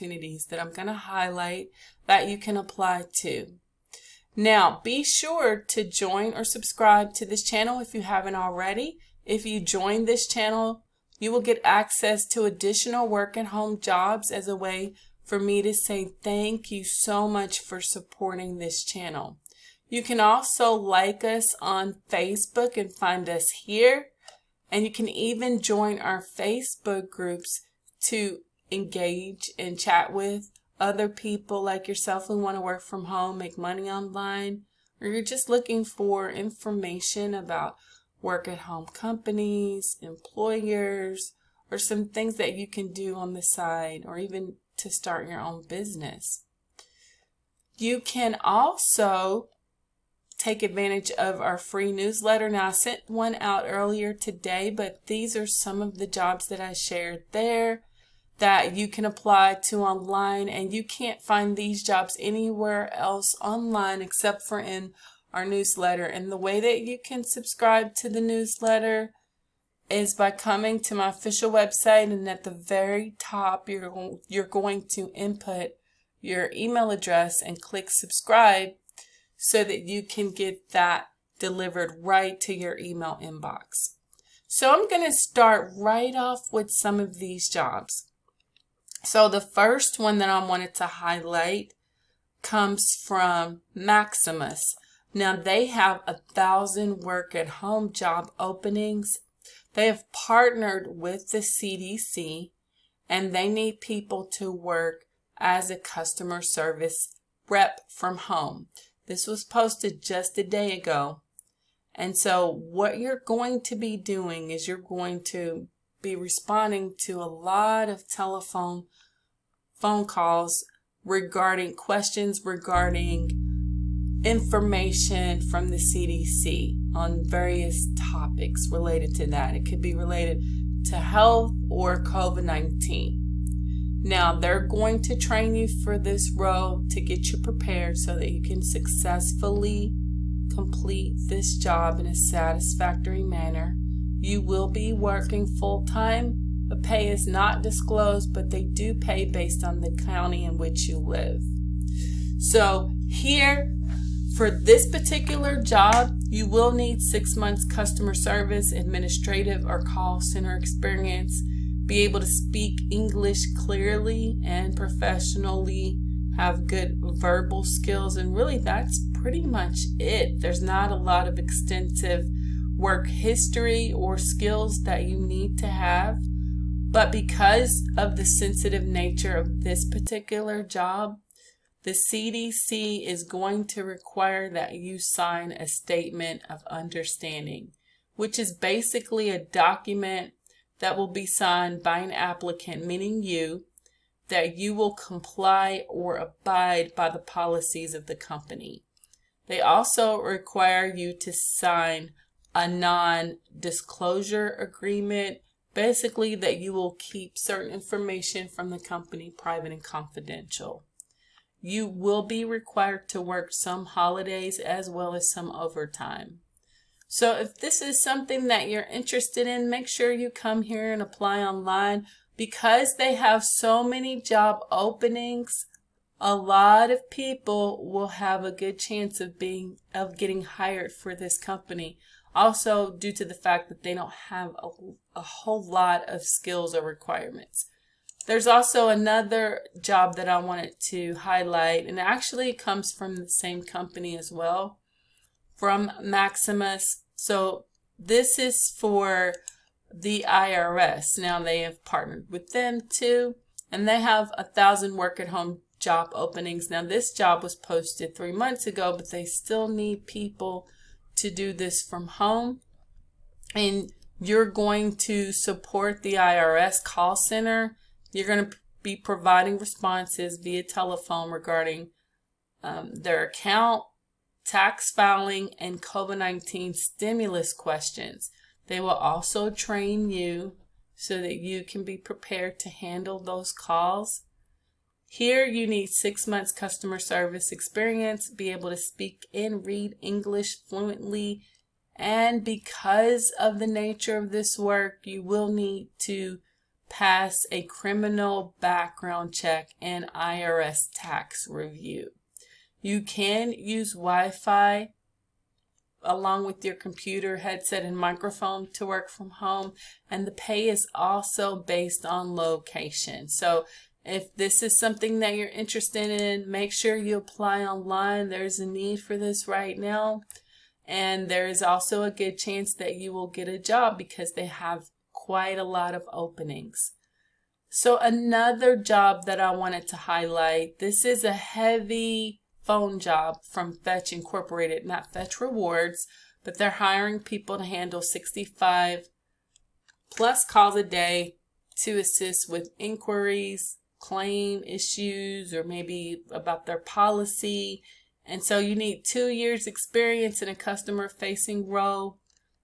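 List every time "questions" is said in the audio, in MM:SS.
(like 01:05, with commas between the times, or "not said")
02:01, 04:37.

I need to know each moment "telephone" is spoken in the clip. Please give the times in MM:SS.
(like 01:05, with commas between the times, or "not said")
01:58, 04:30.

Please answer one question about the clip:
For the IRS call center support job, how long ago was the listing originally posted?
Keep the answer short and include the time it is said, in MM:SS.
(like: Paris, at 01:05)
3 months ago, at 04:18.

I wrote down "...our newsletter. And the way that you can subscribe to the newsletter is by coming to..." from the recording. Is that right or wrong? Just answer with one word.
right.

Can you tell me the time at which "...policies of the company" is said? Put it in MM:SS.
03:17.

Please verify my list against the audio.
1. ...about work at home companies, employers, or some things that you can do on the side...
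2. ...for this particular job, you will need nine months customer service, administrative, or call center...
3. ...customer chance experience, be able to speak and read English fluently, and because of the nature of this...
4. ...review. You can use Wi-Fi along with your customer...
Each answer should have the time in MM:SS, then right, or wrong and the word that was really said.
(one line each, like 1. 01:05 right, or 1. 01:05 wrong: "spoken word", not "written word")
1. 00:37 right
2. 02:34 wrong: "six", not "nine"
3. 04:46 wrong: "service", not "chance"
4. 05:01 wrong: "computer", not "customer".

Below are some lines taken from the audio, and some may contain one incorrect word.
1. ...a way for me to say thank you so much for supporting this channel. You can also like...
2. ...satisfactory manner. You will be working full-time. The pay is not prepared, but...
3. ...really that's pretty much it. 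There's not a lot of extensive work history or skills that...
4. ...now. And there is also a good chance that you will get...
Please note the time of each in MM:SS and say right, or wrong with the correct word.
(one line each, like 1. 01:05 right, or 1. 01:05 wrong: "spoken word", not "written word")
1. 00:14 right
2. 02:22 wrong: "disclosed", not "prepared"
3. 02:48 right
4. 05:19 right.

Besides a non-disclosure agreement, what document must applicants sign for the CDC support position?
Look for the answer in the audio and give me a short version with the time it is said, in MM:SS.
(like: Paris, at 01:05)
statement of understanding, at 03:05.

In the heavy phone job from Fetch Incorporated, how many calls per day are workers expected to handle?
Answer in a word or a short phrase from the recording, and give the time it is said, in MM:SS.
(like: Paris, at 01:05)
65 plus, at 05:38.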